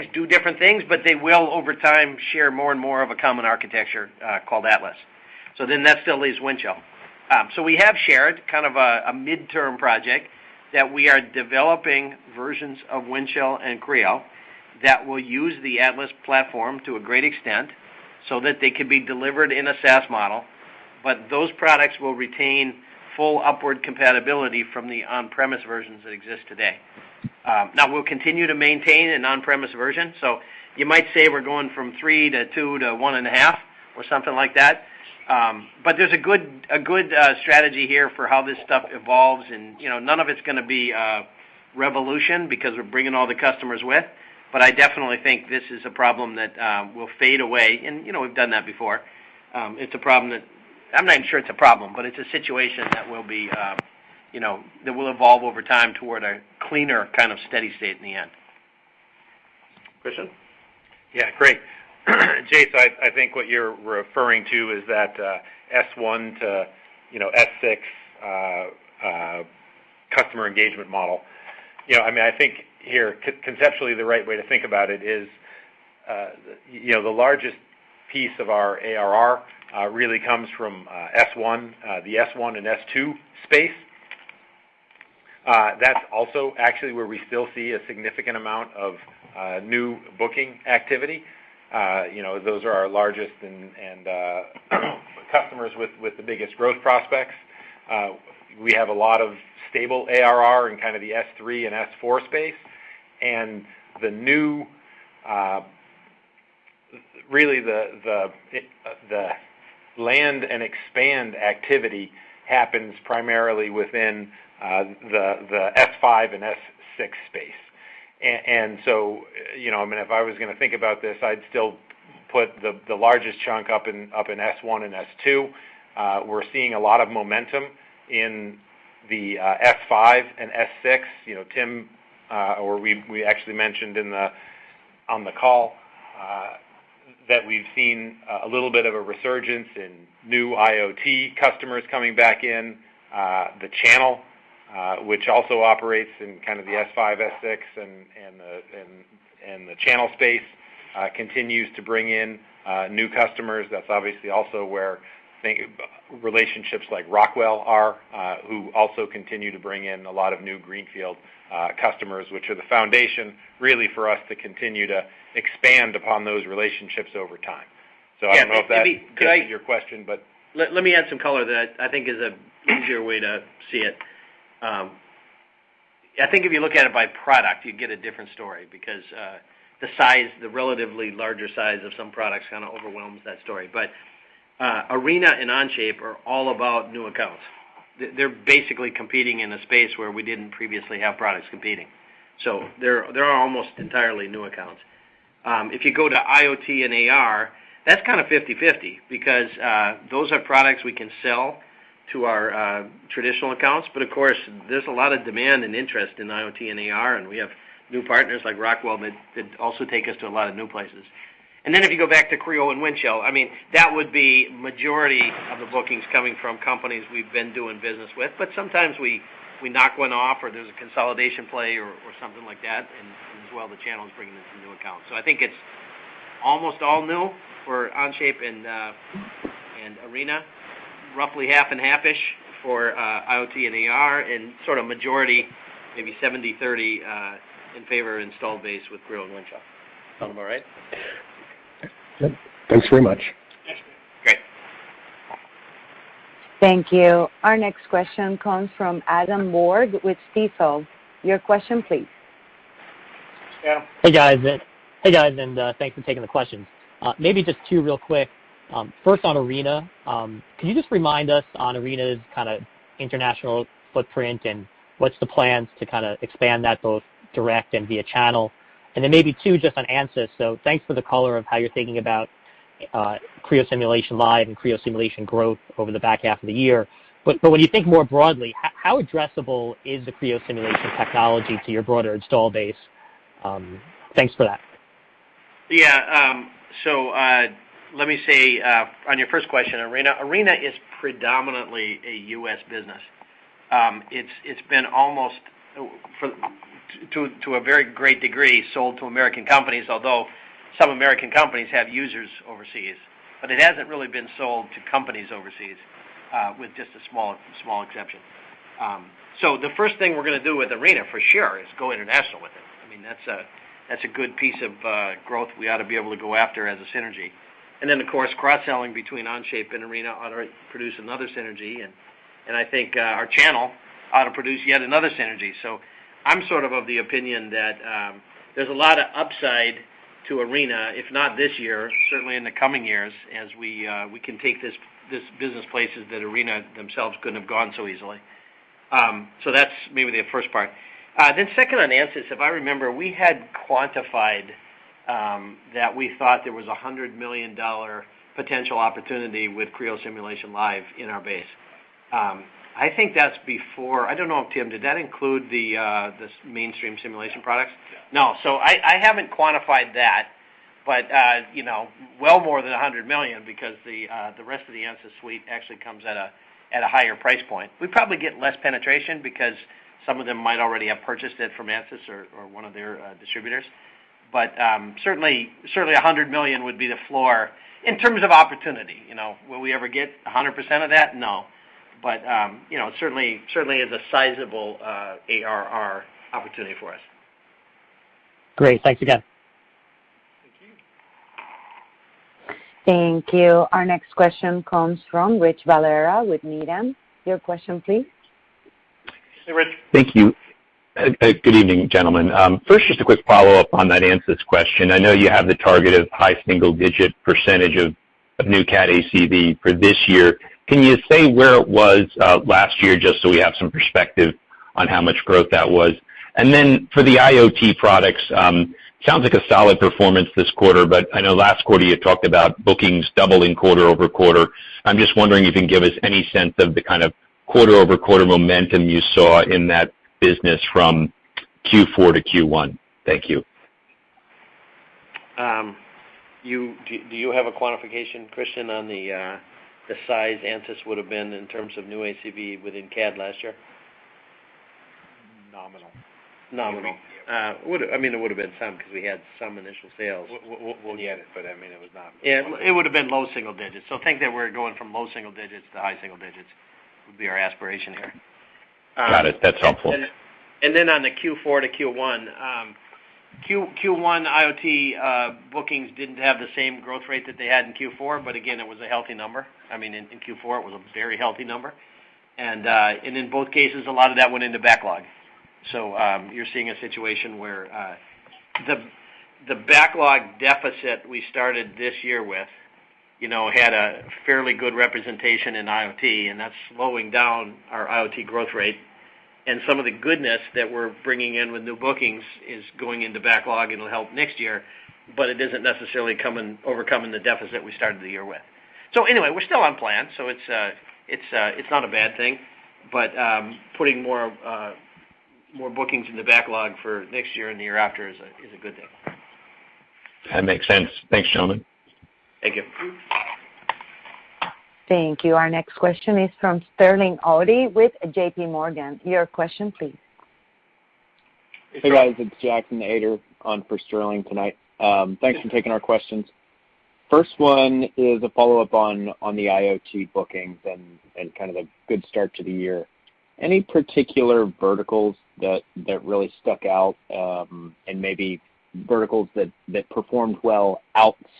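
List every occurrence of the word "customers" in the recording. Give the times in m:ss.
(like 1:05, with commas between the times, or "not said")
0:43, 1:10, 1:35, 2:21, 2:33, 2:41.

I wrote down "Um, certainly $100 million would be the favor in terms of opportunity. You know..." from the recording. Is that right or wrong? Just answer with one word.
wrong.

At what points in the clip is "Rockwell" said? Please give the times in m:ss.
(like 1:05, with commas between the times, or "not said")
2:37, 3:28.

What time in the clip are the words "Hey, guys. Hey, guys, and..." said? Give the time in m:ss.
4:14.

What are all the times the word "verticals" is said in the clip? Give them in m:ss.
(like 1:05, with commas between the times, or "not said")
8:54, 8:58.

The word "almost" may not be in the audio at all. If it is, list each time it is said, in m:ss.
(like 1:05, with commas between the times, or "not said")
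3:13, 3:46, 4:54.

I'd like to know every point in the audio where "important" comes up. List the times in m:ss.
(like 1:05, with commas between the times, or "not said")
not said.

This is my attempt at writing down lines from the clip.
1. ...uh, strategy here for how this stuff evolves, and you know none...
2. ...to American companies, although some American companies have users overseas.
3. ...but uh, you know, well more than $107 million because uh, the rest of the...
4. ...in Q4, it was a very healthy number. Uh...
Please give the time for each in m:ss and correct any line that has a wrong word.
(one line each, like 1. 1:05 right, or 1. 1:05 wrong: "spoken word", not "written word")
1. 0:37 right
2. 4:58 right
3. 6:00 wrong: "100", not "107"
4. 7:49 right.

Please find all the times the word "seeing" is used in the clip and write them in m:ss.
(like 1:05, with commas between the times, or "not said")
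2:06, 7:56.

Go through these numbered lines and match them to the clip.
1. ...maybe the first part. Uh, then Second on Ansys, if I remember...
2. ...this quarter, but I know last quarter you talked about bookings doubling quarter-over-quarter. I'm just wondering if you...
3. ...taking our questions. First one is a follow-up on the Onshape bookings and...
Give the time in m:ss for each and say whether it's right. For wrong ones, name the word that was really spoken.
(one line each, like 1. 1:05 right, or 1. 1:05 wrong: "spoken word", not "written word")
1. 5:39 right
2. 7:00 right
3. 8:45 wrong: "IoT", not "Onshape".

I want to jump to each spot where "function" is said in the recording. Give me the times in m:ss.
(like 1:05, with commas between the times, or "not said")
not said.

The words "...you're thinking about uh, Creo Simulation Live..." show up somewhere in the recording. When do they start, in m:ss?
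4:31.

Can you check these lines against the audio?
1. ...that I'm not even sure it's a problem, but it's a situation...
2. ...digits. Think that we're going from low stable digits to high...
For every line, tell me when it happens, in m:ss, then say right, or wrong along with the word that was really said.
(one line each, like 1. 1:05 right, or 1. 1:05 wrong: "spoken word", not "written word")
1. 0:50 right
2. 7:33 wrong: "single", not "stable".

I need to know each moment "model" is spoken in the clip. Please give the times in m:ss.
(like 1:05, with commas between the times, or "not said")
0:20, 1:10.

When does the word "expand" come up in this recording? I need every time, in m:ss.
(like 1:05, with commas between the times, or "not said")
1:50, 2:45, 4:26.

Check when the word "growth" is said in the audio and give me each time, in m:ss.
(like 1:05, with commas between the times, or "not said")
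1:36, 4:35, 5:15, 6:55, 7:46, 8:08.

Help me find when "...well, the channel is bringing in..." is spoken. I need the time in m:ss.
3:43.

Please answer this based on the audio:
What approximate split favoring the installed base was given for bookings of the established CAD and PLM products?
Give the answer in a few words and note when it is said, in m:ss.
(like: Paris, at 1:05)
70/30, at 3:56.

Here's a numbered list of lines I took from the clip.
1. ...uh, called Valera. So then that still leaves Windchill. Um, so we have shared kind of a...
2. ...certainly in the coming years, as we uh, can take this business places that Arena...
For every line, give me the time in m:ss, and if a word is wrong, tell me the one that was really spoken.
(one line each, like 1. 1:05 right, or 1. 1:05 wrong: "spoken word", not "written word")
1. 0:04 wrong: "Atlas", not "Valera"
2. 5:32 right.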